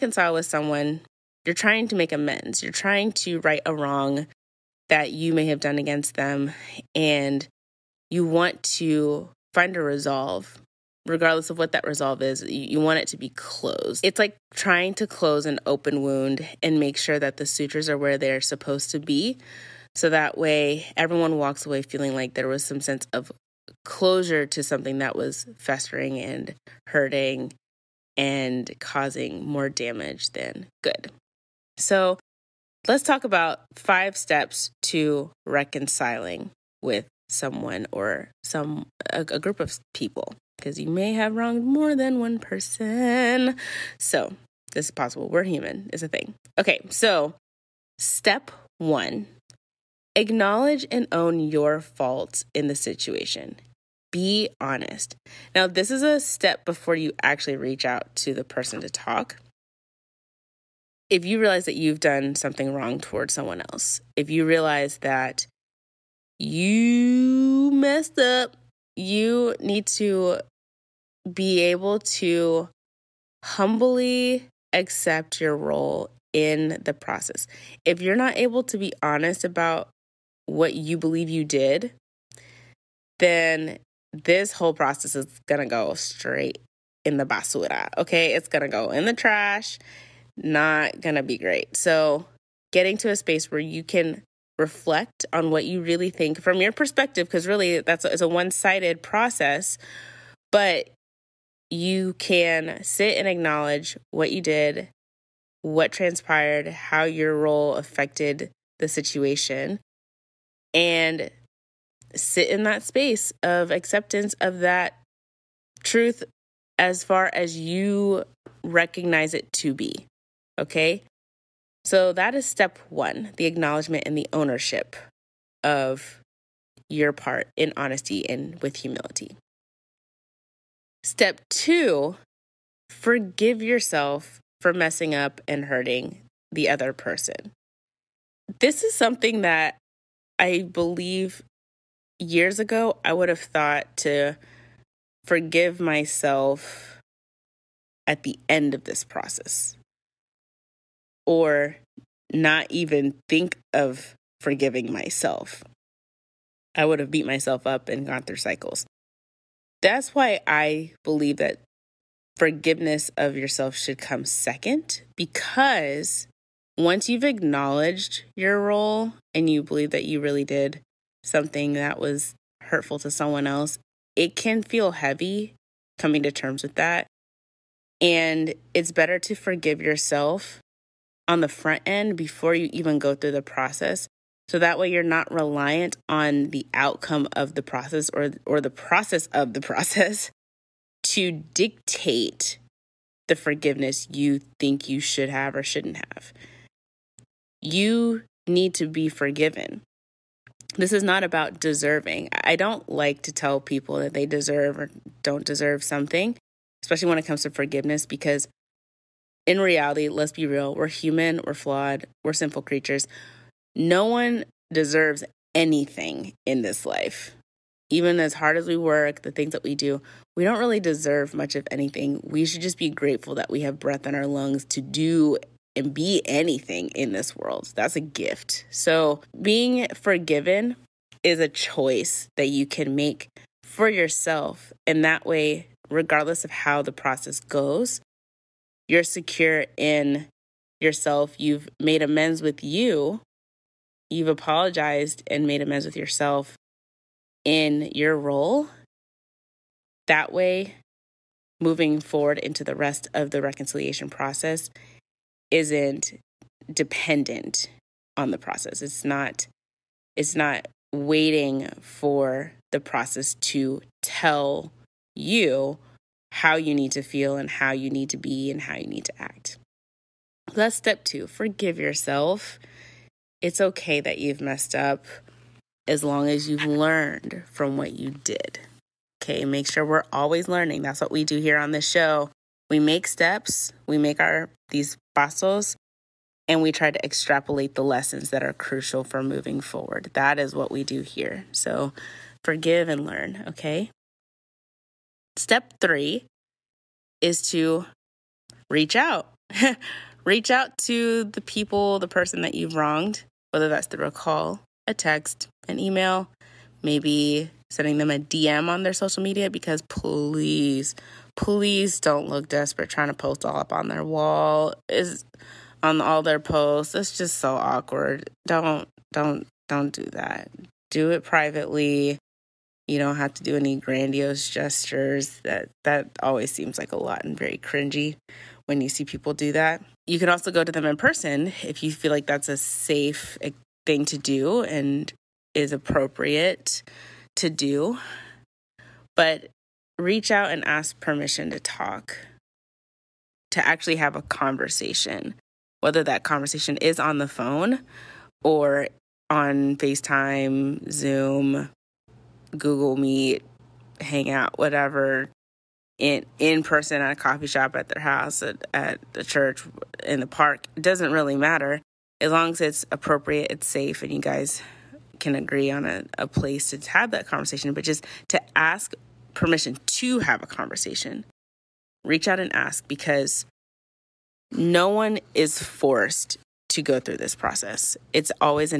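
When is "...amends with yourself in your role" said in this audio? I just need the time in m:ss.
4:05.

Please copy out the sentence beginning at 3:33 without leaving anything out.
No one deserves anything in this life.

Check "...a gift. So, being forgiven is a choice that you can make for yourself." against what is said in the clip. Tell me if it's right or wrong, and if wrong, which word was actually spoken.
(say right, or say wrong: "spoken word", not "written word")
right.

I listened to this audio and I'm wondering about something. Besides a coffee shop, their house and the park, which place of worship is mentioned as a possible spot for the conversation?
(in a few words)
the church.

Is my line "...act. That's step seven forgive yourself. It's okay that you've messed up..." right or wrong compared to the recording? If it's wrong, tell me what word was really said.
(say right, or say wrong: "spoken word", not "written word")
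wrong: "two", not "seven".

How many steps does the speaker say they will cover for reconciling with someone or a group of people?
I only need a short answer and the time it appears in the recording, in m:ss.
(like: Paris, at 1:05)
5, at 0:33.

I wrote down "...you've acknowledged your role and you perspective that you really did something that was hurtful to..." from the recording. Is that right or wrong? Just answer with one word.
wrong.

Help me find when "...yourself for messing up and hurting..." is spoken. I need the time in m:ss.
2:13.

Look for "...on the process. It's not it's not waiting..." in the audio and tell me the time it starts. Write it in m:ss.
4:18.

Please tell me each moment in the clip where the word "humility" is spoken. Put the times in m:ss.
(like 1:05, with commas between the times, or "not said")
2:08.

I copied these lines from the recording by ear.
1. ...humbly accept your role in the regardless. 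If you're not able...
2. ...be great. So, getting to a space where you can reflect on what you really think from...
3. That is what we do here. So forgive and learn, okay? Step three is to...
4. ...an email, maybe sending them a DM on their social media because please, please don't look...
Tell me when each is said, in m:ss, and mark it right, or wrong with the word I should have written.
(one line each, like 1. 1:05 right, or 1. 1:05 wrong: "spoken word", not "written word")
1. 1:13 wrong: "process", not "regardless"
2. 1:31 right
3. 4:50 right
4. 5:05 right.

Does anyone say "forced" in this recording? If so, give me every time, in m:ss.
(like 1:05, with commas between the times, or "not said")
6:15.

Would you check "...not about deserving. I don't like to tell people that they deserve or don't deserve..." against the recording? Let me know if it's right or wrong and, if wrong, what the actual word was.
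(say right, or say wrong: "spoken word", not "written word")
right.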